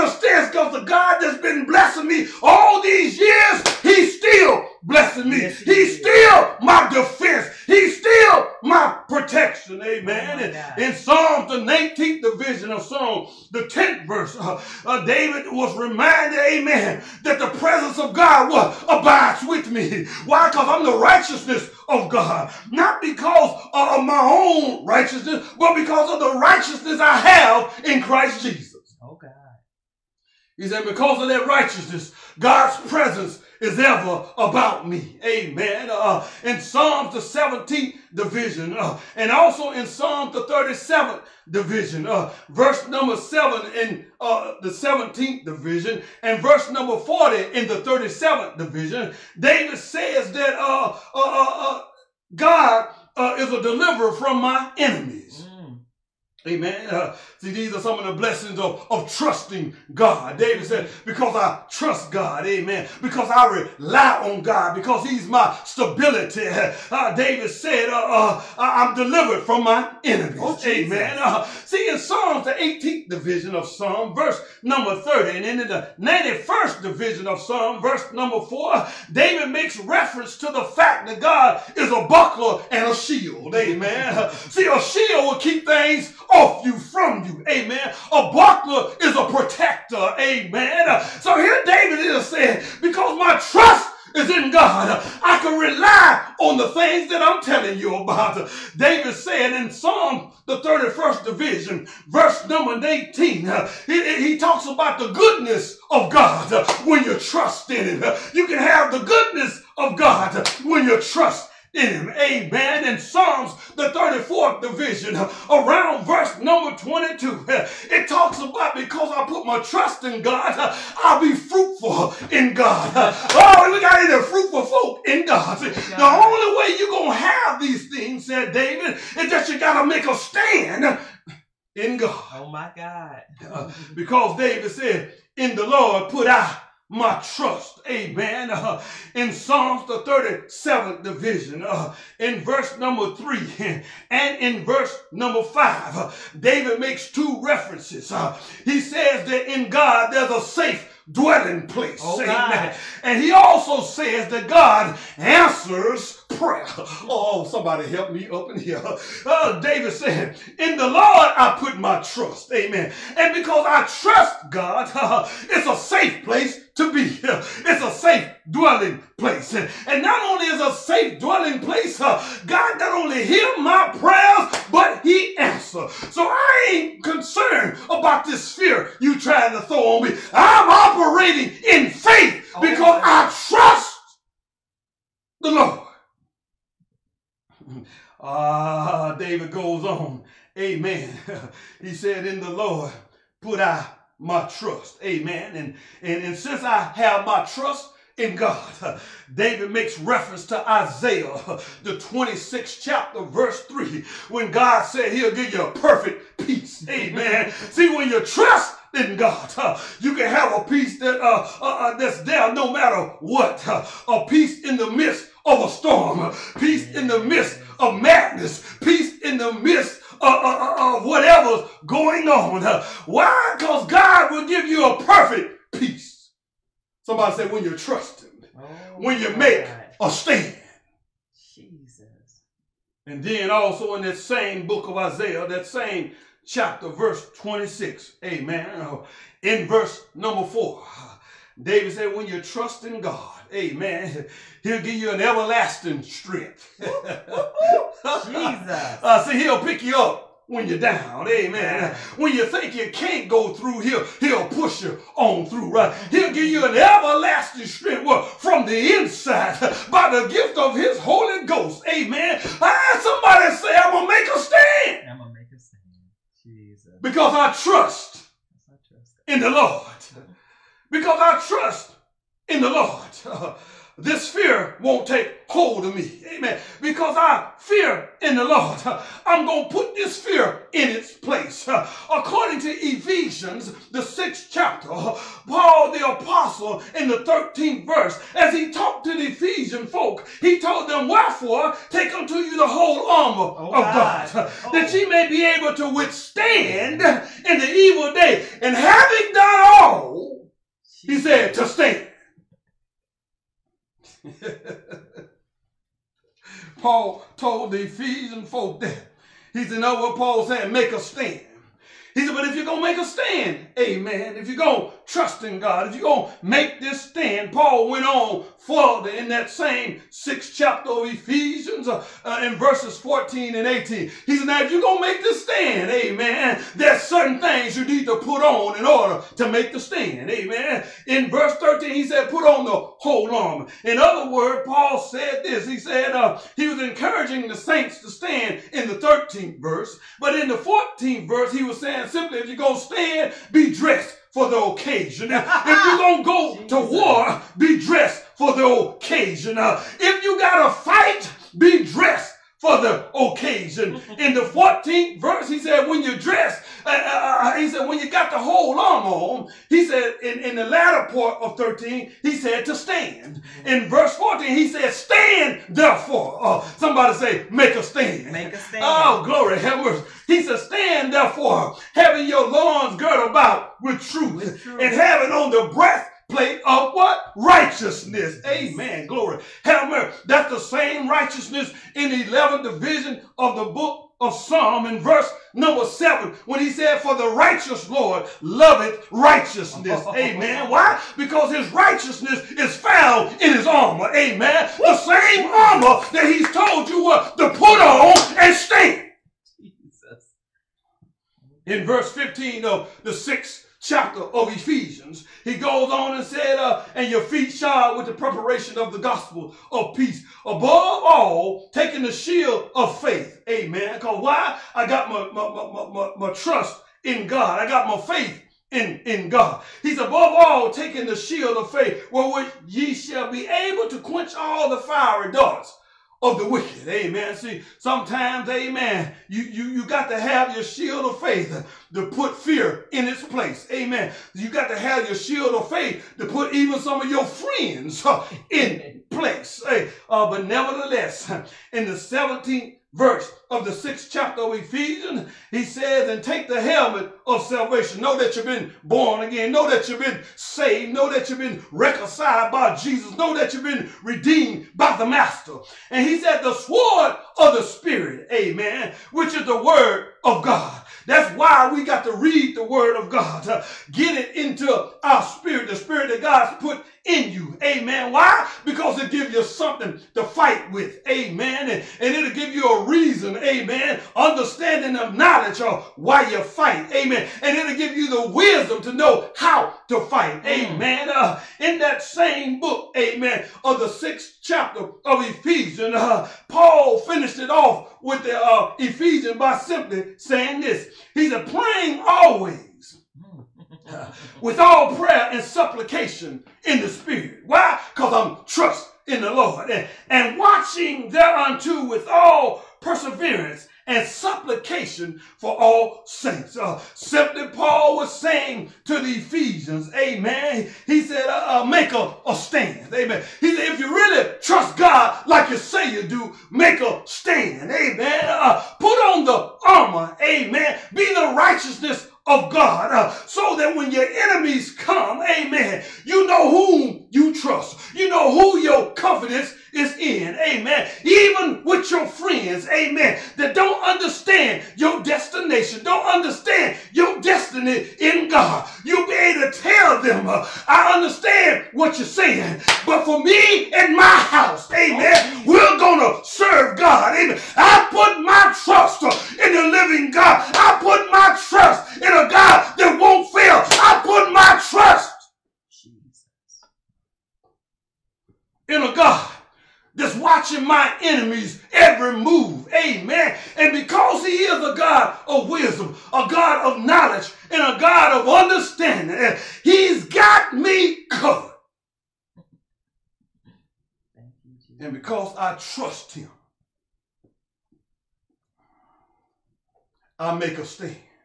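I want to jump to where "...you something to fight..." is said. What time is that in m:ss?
7:49.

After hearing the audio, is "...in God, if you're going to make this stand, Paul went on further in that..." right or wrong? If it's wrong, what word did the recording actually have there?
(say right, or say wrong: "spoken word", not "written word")
right.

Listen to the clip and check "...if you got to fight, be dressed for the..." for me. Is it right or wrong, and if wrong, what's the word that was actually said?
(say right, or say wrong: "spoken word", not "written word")
right.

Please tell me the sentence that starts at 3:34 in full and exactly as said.
a peace in the midst of a storm.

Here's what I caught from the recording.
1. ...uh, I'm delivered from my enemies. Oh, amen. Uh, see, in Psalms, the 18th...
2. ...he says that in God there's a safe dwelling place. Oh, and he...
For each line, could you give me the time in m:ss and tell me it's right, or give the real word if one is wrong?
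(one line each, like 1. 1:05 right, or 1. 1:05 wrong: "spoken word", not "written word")
1. 1:07 right
2. 2:28 right.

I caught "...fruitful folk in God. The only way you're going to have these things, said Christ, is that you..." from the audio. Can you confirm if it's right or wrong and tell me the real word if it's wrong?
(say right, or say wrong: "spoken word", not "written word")
wrong: "David", not "Christ".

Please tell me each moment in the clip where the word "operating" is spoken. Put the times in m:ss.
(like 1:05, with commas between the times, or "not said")
3:00.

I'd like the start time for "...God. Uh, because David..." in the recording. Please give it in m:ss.
2:12.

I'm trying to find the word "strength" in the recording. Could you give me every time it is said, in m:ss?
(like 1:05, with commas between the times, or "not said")
4:06, 4:17.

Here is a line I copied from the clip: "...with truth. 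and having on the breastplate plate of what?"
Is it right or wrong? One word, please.
right.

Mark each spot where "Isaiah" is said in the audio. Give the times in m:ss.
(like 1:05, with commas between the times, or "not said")
3:20, 3:54.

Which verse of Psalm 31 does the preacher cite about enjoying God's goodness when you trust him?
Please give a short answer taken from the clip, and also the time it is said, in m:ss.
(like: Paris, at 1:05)
18, at 1:42.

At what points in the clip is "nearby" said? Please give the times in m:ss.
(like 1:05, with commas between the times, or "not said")
not said.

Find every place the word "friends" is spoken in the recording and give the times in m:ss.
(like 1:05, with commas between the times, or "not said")
7:17, 8:52.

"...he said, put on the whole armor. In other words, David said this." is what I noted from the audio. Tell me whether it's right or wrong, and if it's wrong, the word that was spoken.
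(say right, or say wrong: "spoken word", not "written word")
wrong: "Paul", not "David".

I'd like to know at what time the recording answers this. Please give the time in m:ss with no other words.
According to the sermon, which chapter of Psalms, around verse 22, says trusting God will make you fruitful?
1:53.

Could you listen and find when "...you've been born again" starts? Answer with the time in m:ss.
7:28.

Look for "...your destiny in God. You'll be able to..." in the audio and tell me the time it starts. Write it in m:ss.
8:56.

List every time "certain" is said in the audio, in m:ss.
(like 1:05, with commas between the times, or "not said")
5:27.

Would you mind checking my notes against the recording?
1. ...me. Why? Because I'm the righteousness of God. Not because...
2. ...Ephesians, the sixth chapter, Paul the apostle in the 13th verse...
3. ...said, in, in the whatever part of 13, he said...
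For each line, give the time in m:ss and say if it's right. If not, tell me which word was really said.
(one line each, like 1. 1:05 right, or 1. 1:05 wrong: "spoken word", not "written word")
1. 0:19 right
2. 4:42 right
3. 5:59 wrong: "latter", not "whatever".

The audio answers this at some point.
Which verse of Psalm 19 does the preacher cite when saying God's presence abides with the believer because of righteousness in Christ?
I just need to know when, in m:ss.
0:13.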